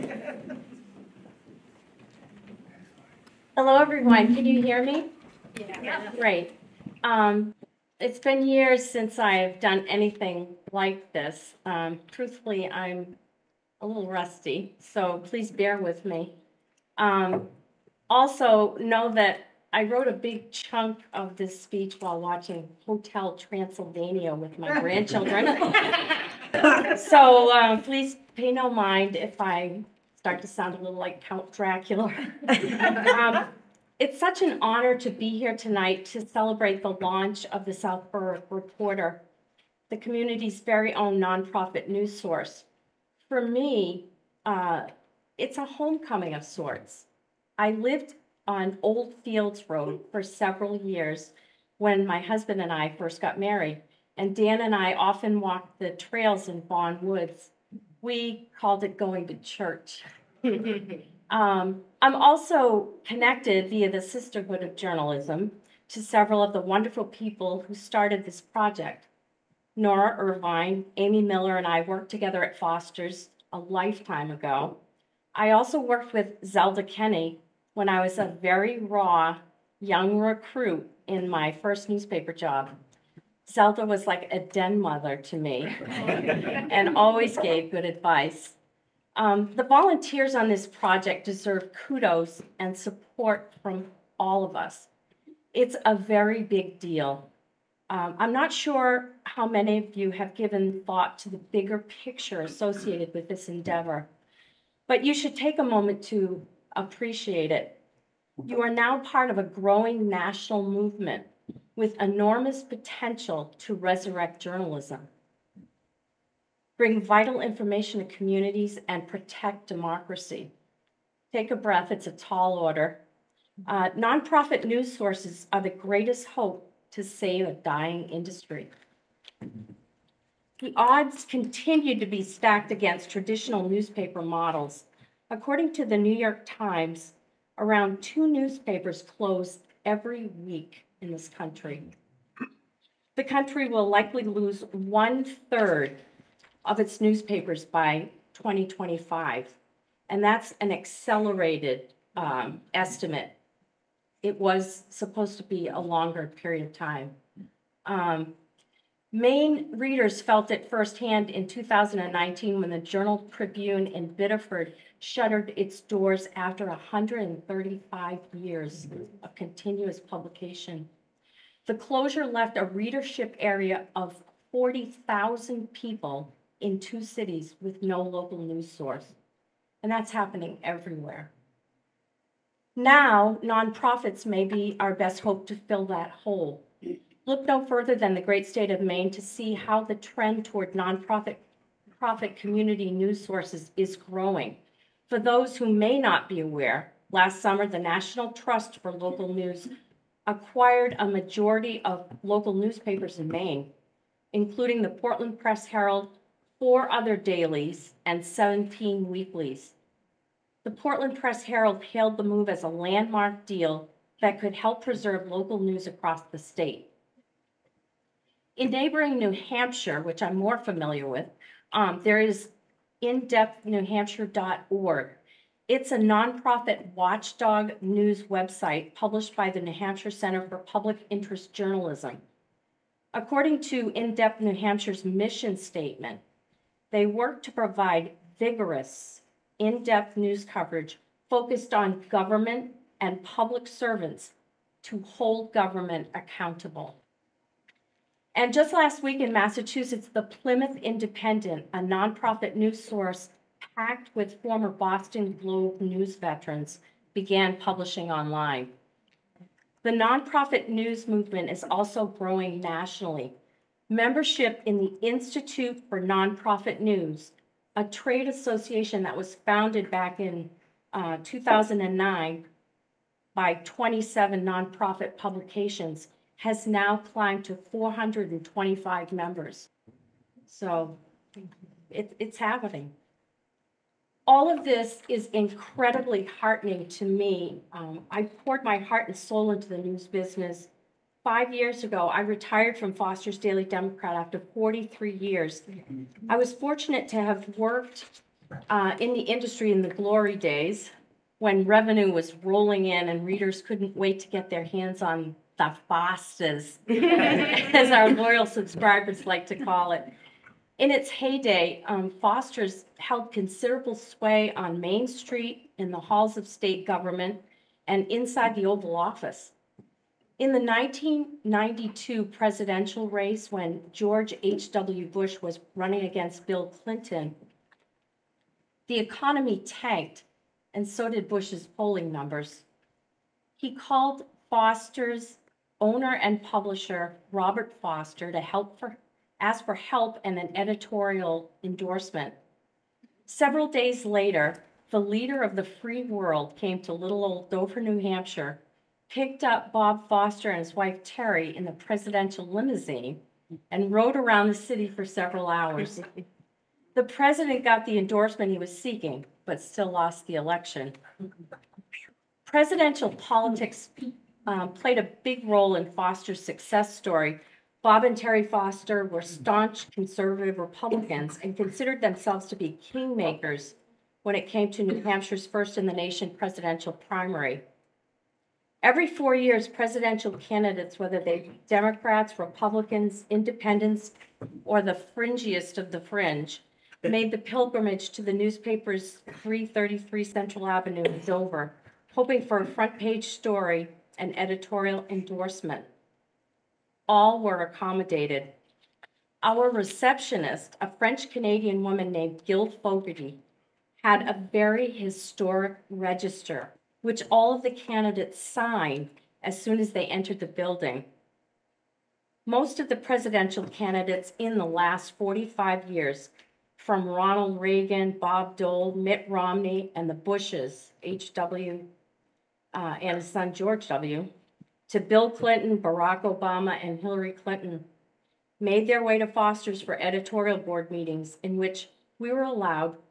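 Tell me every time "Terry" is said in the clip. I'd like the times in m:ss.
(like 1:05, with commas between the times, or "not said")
5:51, 6:08.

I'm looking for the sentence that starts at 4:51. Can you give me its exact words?
Five years ago, I retired from Foster's Daily Democrat after 43 years.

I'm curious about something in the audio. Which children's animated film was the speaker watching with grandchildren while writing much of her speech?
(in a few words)
Hotel Transylvania.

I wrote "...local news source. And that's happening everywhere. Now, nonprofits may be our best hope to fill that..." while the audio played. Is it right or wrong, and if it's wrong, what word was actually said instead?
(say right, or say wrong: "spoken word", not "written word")
right.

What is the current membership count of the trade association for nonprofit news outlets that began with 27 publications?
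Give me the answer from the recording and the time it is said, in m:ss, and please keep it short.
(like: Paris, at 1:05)
425, at 4:37.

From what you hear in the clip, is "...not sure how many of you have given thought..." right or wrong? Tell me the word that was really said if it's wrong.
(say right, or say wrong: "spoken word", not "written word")
right.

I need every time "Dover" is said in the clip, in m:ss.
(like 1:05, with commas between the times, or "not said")
5:47, 6:31.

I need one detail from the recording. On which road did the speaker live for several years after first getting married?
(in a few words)
Old Fields Road.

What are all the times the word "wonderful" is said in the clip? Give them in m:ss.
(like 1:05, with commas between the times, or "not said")
1:06.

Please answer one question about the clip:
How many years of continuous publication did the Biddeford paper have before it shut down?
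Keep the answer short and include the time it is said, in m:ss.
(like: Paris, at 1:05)
135, at 2:46.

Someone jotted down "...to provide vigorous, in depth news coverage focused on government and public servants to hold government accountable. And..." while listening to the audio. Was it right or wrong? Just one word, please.
right.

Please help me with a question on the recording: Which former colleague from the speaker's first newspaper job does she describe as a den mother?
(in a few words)
Zelda Kenny.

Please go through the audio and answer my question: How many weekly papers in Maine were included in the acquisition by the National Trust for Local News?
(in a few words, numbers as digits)
17.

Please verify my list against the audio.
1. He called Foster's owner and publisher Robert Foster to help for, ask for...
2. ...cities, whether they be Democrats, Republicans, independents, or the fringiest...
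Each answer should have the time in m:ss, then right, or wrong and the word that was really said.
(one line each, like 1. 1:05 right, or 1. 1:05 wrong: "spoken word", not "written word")
1. 5:33 right
2. 6:20 wrong: "candidates", not "cities".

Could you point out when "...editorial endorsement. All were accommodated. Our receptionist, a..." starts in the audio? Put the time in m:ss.
6:34.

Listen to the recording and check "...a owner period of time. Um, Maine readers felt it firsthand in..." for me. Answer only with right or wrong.
wrong.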